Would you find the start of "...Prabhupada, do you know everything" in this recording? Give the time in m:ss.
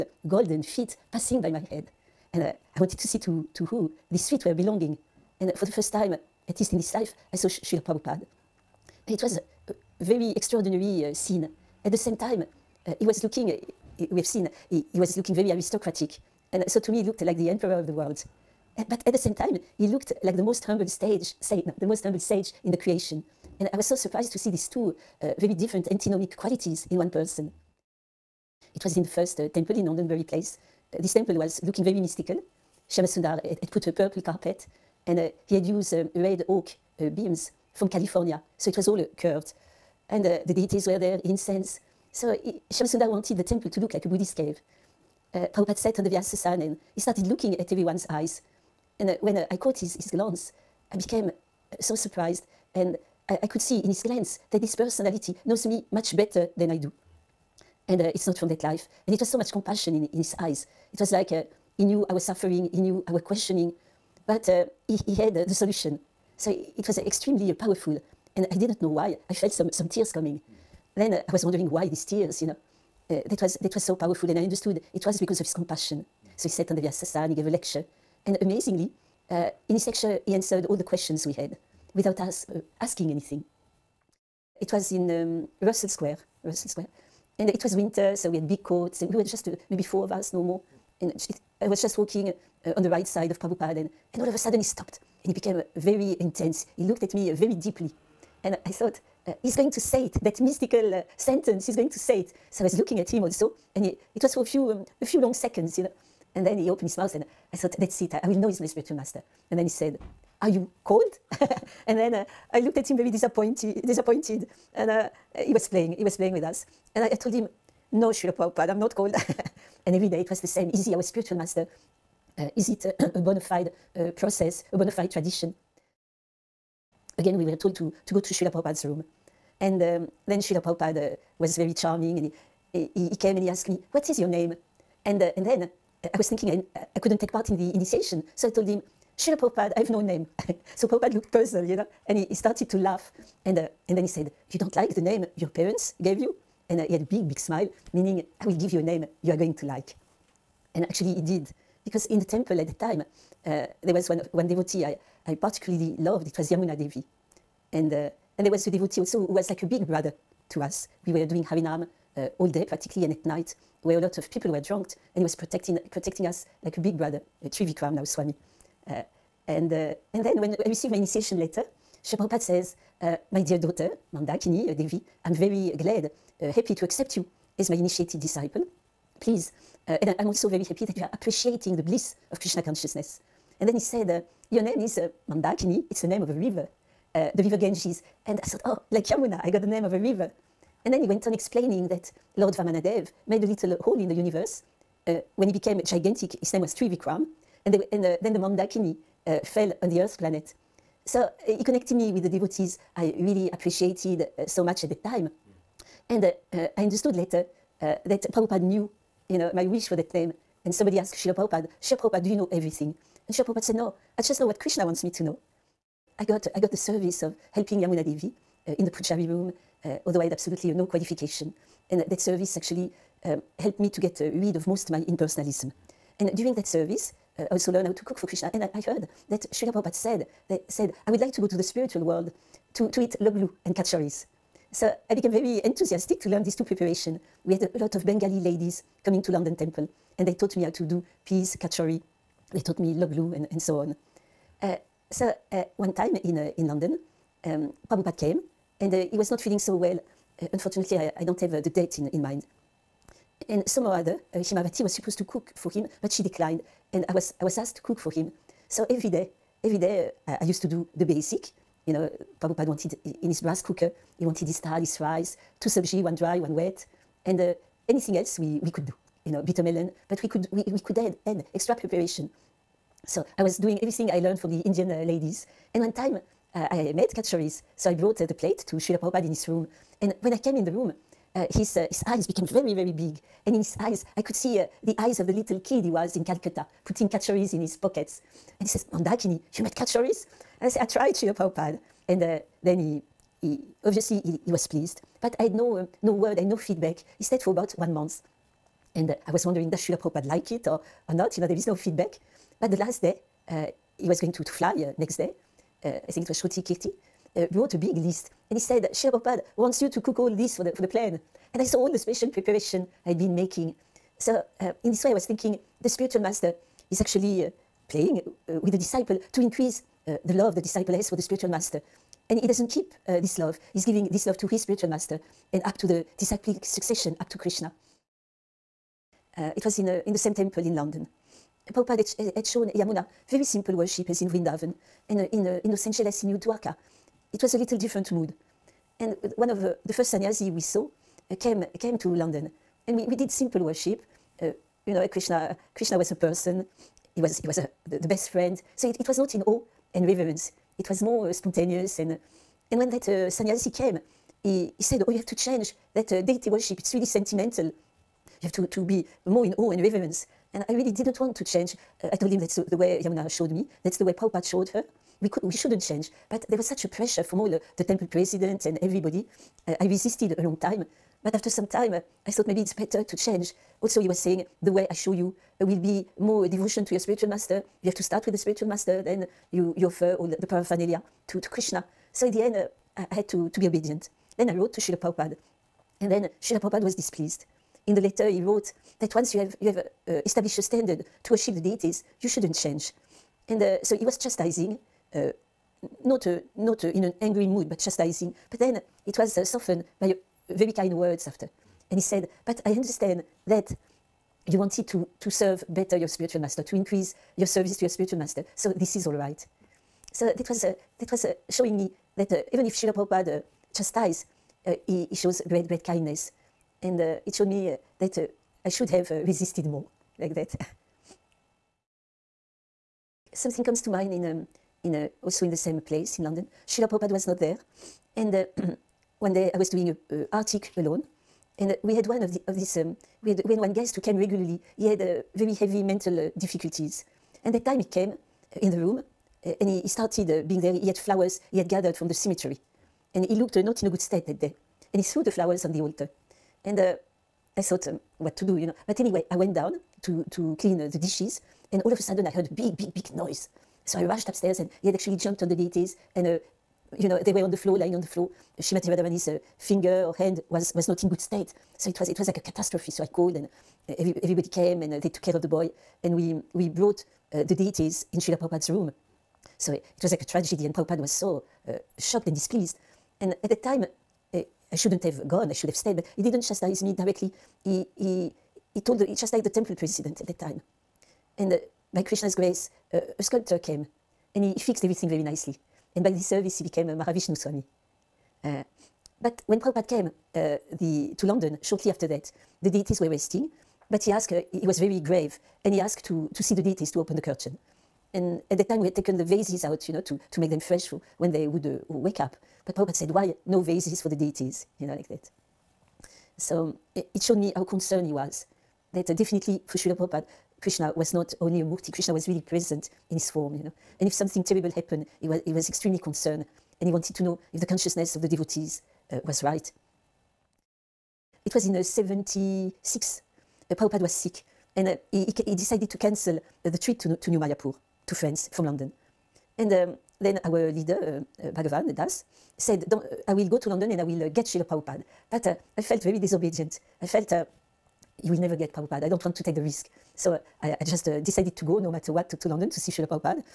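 3:31.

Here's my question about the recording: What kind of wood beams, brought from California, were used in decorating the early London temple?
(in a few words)
Red oak.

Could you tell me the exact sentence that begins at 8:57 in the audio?
I felt, uh, you will never get Prabhupada.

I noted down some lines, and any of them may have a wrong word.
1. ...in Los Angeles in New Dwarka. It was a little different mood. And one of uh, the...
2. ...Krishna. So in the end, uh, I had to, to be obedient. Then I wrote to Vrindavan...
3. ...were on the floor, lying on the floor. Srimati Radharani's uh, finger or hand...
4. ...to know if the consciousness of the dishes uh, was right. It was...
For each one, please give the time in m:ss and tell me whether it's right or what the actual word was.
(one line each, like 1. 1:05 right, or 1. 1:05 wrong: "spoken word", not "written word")
1. 5:35 right
2. 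6:21 wrong: "Srila", not "Vrindavan"
3. 7:37 right
4. 8:37 wrong: "devotees", not "dishes".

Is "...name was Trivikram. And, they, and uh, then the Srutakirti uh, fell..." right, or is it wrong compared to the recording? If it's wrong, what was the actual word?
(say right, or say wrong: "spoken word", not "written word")
wrong: "Mandakini", not "Srutakirti".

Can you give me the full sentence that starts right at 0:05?
And uh, for the first time, at least in this life, I saw Srila Prabhupada it was a very extraordinary euh, scene.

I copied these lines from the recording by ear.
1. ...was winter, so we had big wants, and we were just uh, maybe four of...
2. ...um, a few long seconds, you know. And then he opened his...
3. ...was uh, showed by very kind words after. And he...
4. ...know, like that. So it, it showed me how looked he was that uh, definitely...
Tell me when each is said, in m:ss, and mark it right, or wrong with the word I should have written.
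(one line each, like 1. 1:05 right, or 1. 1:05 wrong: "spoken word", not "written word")
1. 1:27 wrong: "coats", not "wants"
2. 1:44 right
3. 6:39 wrong: "softened", not "showed"
4. 8:24 wrong: "concerned", not "looked".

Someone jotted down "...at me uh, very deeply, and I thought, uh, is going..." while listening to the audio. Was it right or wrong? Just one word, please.
right.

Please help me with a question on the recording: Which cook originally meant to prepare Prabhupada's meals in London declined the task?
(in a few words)
Himavati.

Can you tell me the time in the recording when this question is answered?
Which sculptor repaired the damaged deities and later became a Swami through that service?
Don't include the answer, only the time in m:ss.
8:06.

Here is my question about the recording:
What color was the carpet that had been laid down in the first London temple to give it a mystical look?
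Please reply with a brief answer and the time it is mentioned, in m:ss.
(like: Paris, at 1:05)
Purple, at 0:33.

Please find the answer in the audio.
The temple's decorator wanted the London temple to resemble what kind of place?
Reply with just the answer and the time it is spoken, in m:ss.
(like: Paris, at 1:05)
A Buddhist cave, at 0:44.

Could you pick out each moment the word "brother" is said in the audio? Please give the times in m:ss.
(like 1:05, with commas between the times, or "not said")
2:39, 2:46.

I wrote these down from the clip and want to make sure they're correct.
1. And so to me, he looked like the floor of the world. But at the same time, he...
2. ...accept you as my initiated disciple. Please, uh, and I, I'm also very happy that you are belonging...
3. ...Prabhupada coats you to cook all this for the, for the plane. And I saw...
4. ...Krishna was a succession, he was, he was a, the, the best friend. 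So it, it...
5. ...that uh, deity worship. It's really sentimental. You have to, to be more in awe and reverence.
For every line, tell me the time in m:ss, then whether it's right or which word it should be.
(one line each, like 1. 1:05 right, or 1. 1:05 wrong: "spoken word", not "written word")
1. 0:16 wrong: "emperor", not "floor"
2. 2:56 wrong: "appreciating", not "belonging"
3. 5:09 wrong: "wants", not "coats"
4. 5:45 wrong: "person", not "succession"
5. 5:55 right.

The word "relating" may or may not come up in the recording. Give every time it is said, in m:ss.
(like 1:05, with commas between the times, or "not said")
not said.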